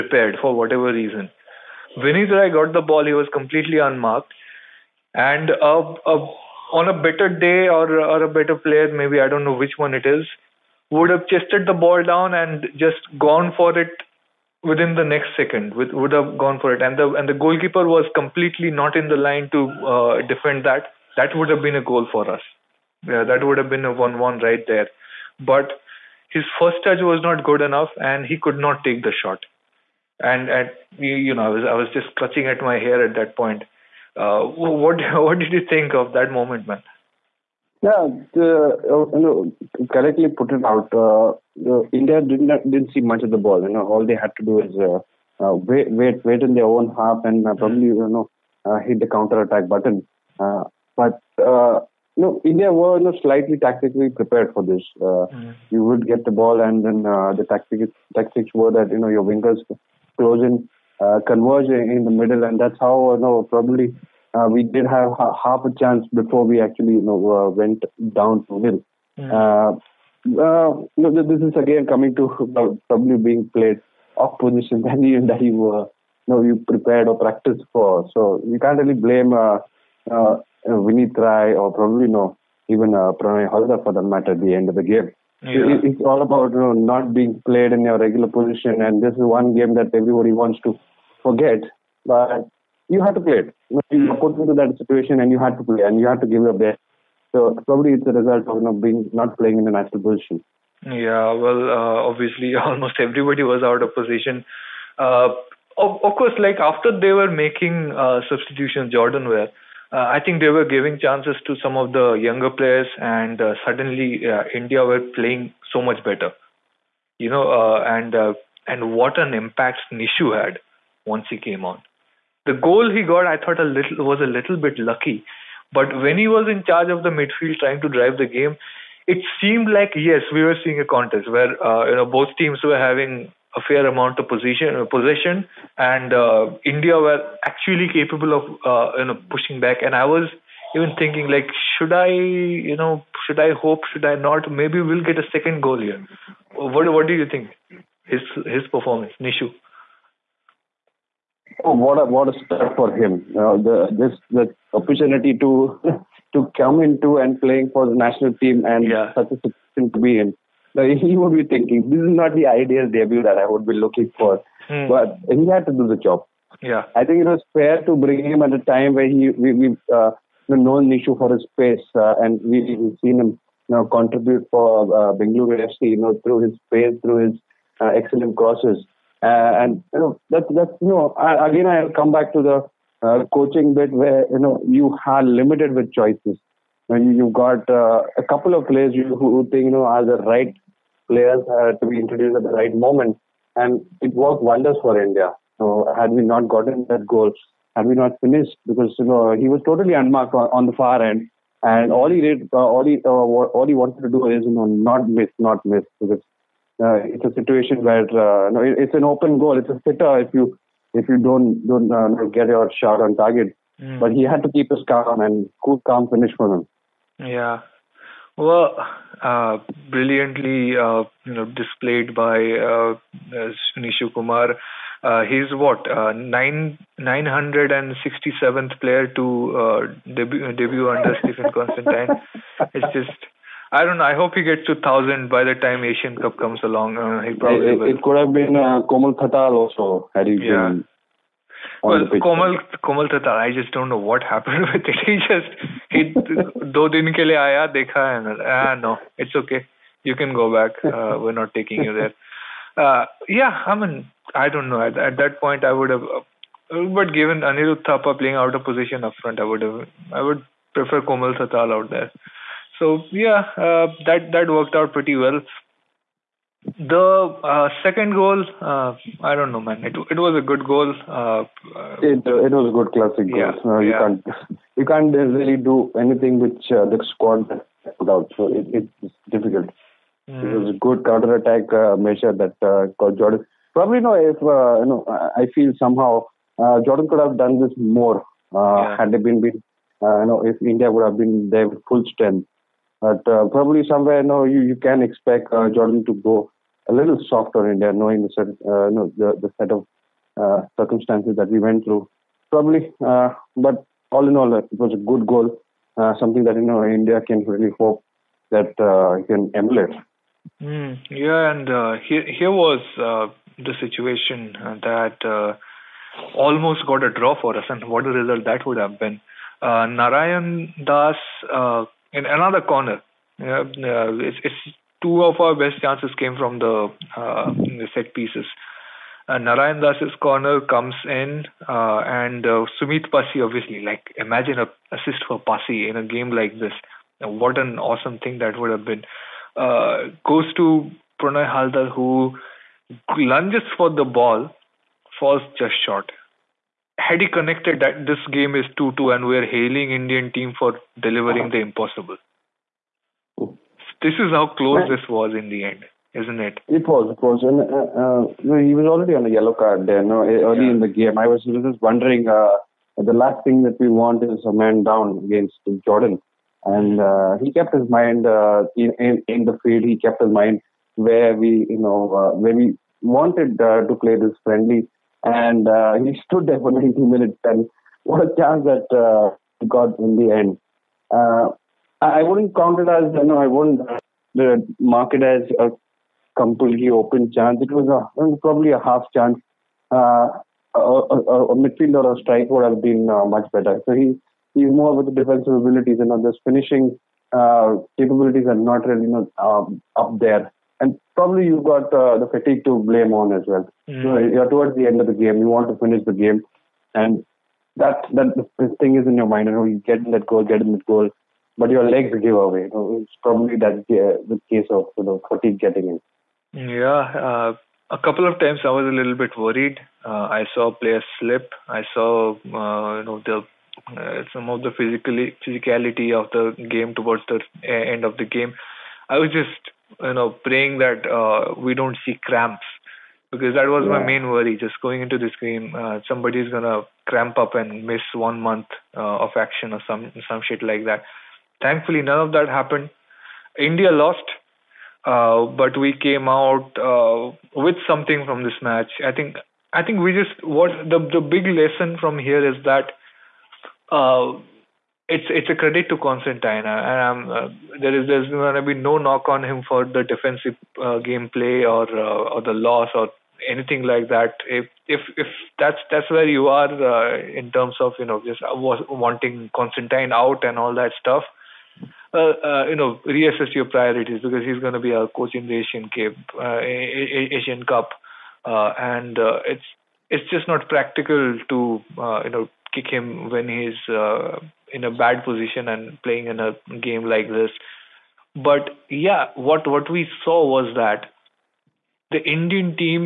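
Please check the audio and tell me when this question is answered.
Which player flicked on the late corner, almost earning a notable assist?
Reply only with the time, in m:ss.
5:32.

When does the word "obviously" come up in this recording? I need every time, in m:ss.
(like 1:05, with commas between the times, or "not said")
1:42, 5:33.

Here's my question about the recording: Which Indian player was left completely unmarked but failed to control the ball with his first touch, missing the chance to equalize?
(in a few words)
Vinit Rai.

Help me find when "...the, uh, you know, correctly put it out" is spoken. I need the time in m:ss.
0:38.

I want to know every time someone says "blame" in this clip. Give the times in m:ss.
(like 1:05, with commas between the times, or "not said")
1:18, 6:42.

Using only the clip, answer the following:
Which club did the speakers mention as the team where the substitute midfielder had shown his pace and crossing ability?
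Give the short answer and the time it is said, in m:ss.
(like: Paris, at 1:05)
Bengaluru FC, at 2:55.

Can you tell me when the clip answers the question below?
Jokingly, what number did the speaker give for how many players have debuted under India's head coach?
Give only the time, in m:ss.
3:46.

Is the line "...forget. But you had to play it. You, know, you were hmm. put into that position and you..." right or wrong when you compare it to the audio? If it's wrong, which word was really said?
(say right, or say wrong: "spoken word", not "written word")
wrong: "situation", not "position".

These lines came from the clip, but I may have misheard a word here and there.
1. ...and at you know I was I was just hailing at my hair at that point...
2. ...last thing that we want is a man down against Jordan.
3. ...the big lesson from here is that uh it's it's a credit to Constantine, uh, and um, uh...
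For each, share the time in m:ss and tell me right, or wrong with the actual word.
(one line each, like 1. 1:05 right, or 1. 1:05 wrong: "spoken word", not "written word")
1. 0:30 wrong: "clutching", not "hailing"
2. 6:03 right
3. 7:31 right.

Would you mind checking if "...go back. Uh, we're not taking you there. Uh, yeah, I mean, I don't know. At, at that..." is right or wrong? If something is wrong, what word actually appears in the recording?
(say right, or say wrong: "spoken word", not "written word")
right.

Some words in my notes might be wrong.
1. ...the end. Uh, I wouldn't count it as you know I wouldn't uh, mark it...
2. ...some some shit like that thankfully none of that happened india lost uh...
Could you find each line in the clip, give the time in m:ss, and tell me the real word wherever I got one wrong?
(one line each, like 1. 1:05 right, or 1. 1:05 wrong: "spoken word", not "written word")
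1. 6:20 right
2. 7:19 right.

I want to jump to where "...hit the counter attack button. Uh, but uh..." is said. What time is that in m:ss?
0:48.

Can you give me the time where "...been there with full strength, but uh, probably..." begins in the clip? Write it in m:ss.
4:51.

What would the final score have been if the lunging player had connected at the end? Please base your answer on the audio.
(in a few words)
2-2.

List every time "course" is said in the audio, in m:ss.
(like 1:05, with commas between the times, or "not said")
1:46.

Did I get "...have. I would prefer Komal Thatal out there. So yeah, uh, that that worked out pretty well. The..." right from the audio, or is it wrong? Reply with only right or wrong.
right.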